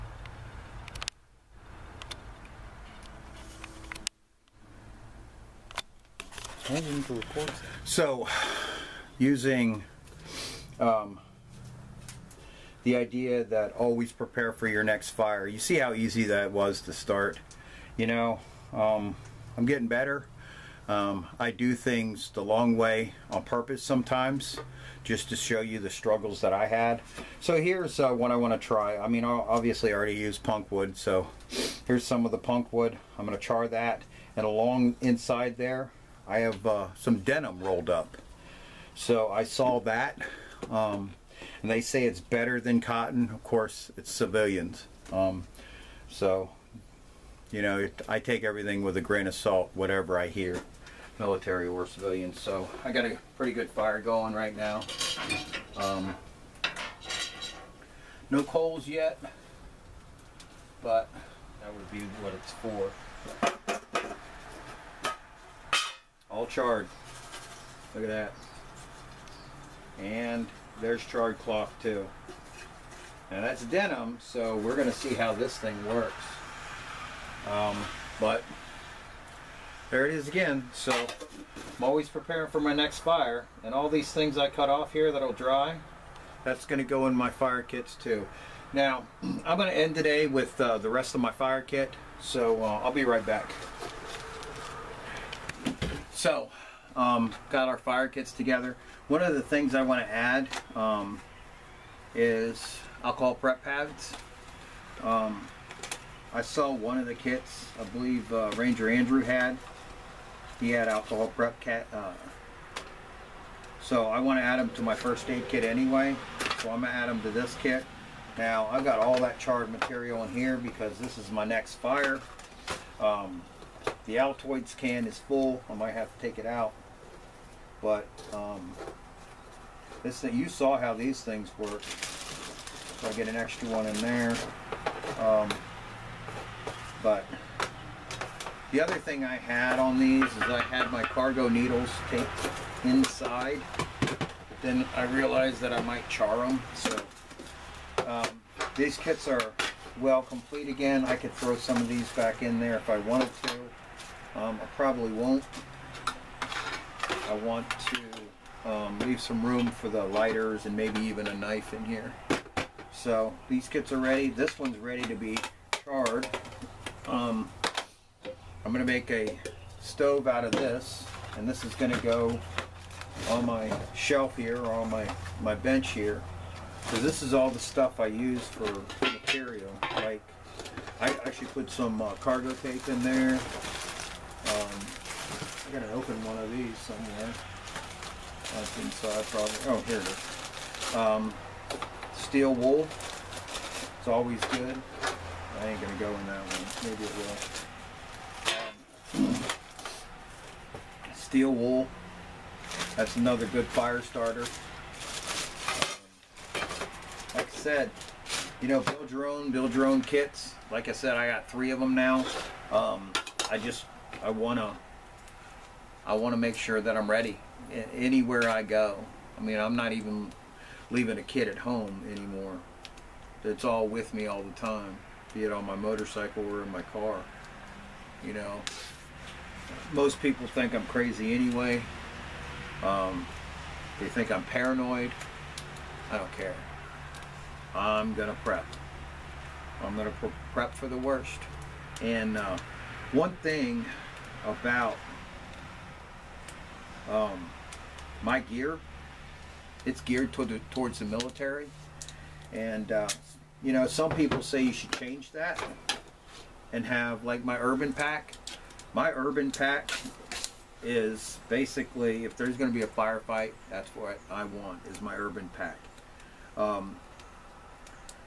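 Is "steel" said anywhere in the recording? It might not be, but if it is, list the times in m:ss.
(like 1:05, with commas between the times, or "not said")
3:12, 3:21.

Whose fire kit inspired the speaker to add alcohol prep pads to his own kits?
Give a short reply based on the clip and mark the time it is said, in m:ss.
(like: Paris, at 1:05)
Ranger Andrew, at 1:48.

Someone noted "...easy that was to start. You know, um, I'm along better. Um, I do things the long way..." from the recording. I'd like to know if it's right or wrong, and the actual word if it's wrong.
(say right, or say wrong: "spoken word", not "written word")
wrong: "getting", not "along".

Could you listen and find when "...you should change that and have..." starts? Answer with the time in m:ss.
4:14.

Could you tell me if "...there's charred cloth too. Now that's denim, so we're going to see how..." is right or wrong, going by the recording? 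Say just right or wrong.
right.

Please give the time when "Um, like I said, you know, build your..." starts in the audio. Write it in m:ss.
3:26.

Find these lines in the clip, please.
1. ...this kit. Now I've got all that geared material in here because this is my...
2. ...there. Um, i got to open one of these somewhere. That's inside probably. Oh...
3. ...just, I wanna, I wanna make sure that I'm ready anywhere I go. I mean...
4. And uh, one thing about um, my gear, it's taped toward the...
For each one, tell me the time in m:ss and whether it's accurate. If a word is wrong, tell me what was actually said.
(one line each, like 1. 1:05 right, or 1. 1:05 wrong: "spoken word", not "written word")
1. 1:57 wrong: "charred", not "geared"
2. 3:03 right
3. 3:33 right
4. 4:02 wrong: "geared", not "taped".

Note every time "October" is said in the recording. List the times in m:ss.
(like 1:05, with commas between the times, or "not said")
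not said.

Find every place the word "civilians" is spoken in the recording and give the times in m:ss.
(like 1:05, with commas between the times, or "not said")
0:44, 0:51.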